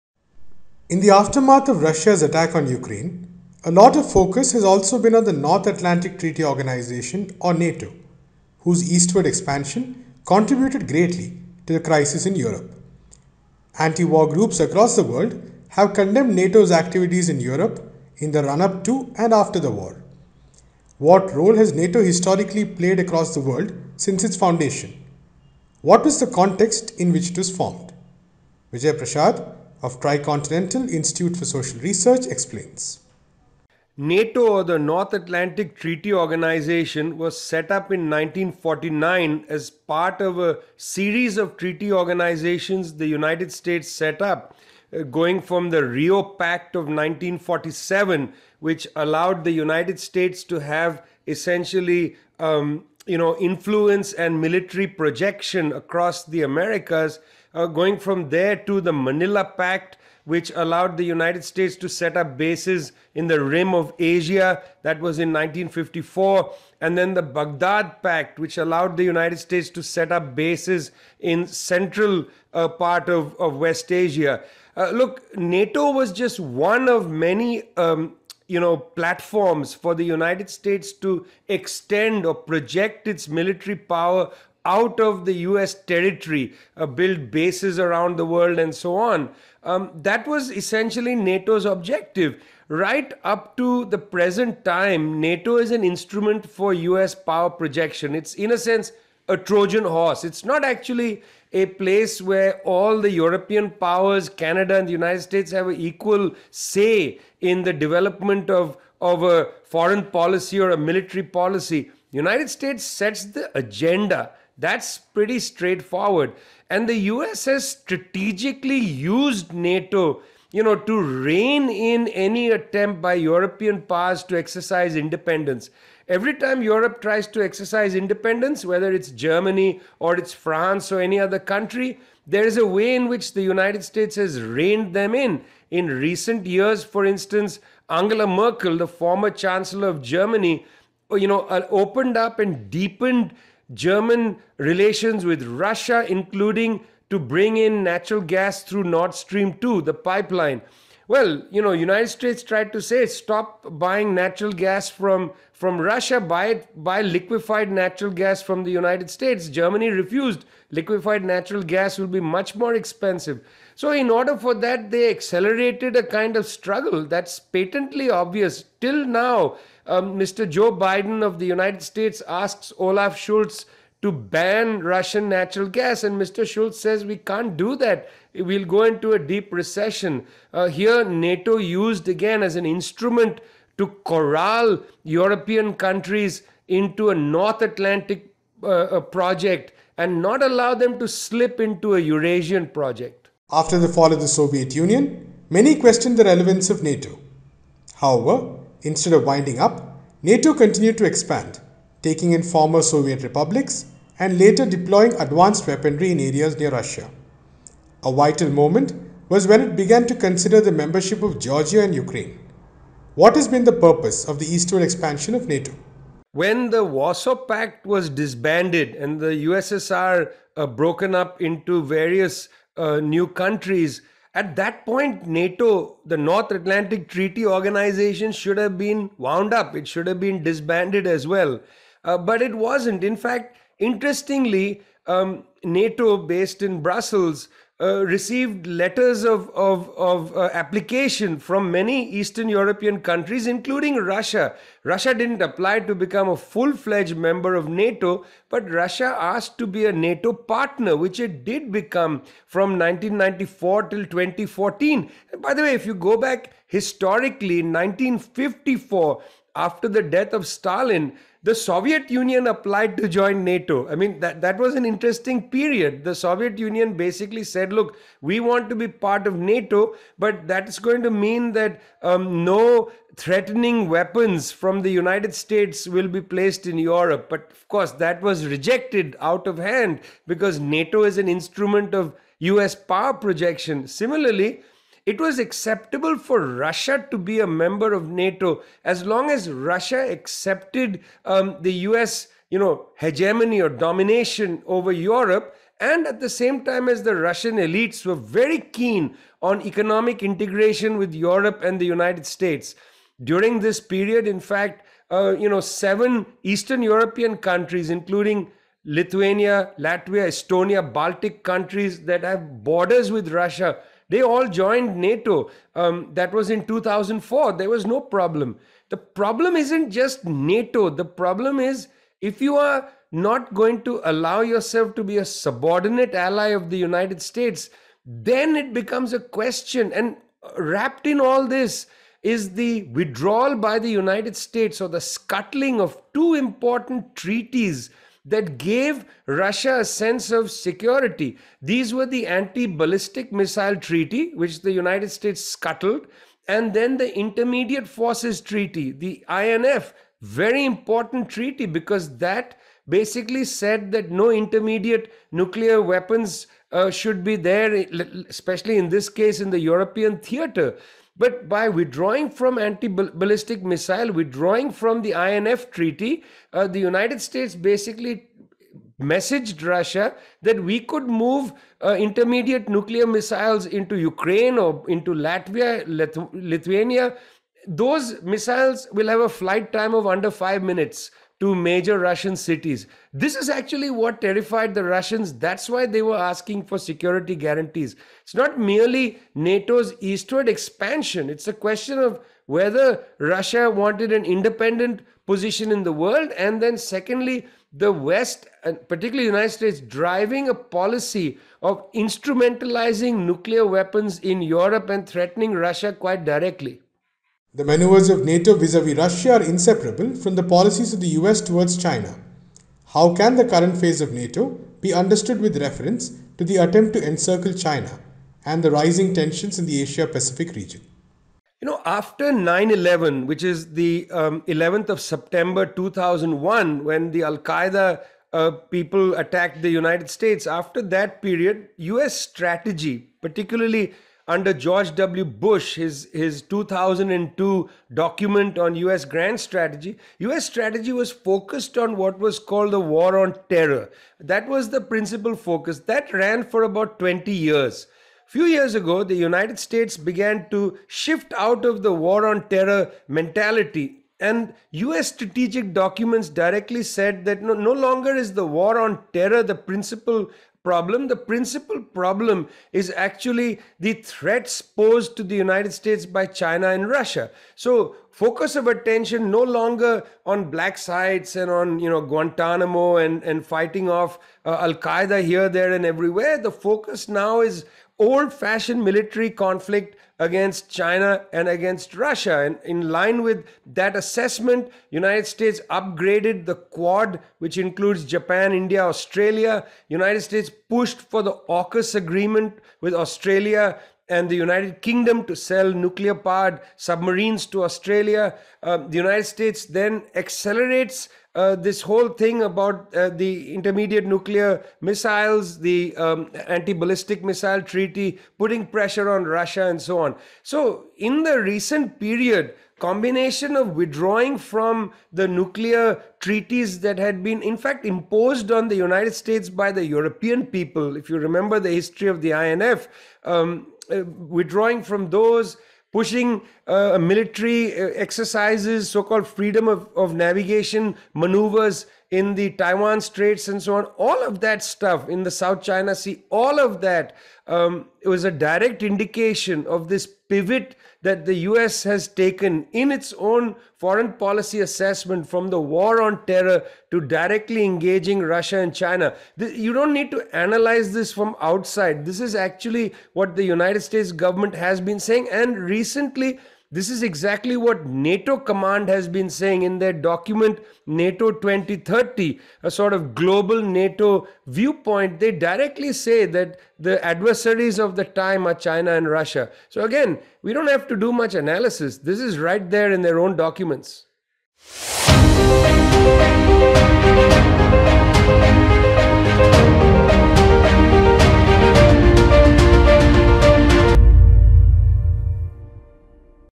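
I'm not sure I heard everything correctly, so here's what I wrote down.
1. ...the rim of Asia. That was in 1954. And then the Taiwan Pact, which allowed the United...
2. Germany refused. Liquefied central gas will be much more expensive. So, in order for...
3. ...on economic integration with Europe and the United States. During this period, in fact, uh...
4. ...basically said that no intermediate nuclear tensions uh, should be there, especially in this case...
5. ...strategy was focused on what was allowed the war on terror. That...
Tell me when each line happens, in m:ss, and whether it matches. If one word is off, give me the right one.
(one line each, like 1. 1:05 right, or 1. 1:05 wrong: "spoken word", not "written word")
1. 1:03 wrong: "Baghdad", not "Taiwan"
2. 2:39 wrong: "natural", not "central"
3. 4:59 right
4. 5:52 wrong: "weapons", not "tensions"
5. 7:20 wrong: "called", not "allowed".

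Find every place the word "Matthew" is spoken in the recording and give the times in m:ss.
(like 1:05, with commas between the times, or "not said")
not said.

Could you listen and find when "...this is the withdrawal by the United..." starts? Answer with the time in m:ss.
5:31.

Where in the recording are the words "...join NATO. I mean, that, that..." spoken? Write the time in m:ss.
4:23.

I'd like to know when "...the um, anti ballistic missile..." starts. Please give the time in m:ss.
8:25.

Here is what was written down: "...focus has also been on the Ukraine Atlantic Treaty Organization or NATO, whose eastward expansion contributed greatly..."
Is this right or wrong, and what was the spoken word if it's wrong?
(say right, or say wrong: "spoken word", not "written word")
wrong: "North", not "Ukraine".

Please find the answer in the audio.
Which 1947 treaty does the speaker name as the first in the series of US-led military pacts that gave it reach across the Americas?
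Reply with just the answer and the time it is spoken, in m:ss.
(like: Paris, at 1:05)
Rio Pact, at 0:45.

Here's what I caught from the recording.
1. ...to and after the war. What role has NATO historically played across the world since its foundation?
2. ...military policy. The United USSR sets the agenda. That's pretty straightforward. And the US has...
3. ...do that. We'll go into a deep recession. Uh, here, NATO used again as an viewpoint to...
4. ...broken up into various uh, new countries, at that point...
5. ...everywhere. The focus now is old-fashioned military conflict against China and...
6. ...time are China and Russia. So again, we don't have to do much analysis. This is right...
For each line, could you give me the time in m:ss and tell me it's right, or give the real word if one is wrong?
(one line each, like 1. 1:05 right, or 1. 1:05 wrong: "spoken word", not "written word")
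1. 0:18 right
2. 1:50 wrong: "States", not "USSR"
3. 2:57 wrong: "instrument", not "viewpoint"
4. 3:40 right
5. 7:55 right
6. 9:28 right.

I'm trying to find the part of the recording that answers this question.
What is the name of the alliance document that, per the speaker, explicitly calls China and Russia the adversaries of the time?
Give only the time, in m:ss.
9:20.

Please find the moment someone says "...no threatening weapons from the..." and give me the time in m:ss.
4:32.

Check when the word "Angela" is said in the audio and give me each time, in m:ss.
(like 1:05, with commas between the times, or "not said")
2:17.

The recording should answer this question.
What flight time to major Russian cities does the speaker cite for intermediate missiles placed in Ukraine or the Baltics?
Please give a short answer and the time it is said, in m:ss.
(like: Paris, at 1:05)
under 5 minutes, at 6:20.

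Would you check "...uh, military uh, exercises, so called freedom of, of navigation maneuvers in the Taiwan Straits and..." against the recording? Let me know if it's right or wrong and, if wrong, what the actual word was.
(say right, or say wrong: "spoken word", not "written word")
right.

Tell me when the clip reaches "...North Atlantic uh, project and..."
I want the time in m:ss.
3:07.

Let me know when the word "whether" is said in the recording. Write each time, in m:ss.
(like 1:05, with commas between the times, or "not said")
2:08, 6:32.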